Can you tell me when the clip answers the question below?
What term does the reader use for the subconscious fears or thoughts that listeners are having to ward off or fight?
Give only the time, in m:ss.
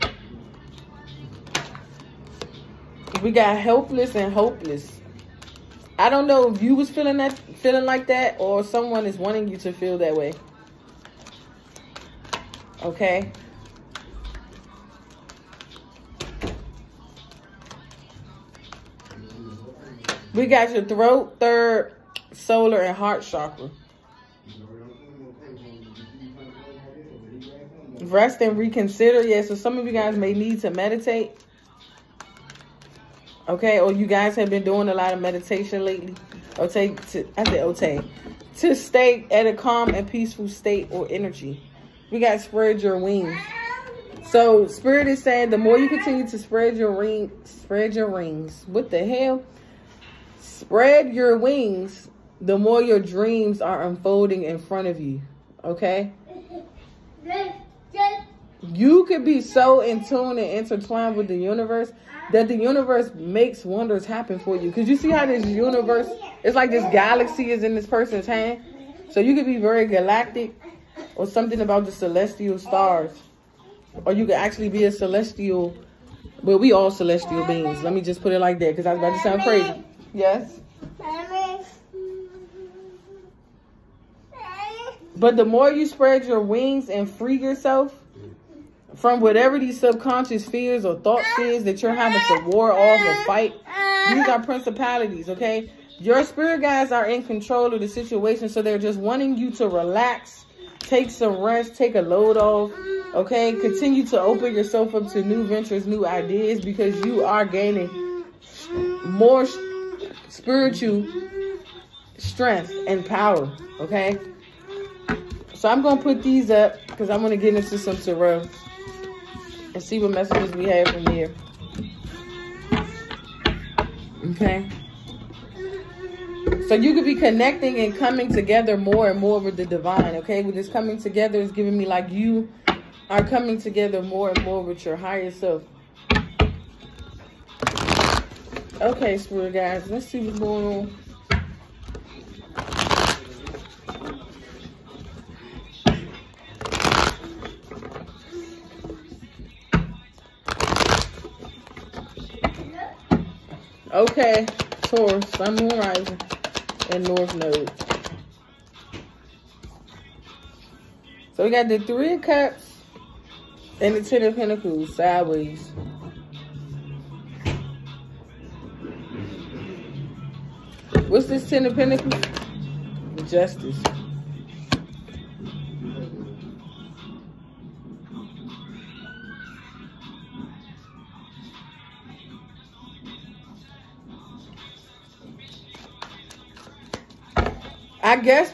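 1:34.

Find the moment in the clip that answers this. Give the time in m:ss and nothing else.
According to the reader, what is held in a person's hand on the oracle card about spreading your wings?
1:06.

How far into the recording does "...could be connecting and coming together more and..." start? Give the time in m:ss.
2:06.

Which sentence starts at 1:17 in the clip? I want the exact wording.
Let me just put it like that because I was about to sound crazy.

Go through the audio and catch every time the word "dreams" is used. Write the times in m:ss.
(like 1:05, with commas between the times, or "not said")
0:52.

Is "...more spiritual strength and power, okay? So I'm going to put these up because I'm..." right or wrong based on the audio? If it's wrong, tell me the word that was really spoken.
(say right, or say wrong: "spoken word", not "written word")
right.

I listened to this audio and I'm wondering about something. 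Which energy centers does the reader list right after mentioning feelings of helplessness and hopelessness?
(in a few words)
Throat, third, solar, and heart.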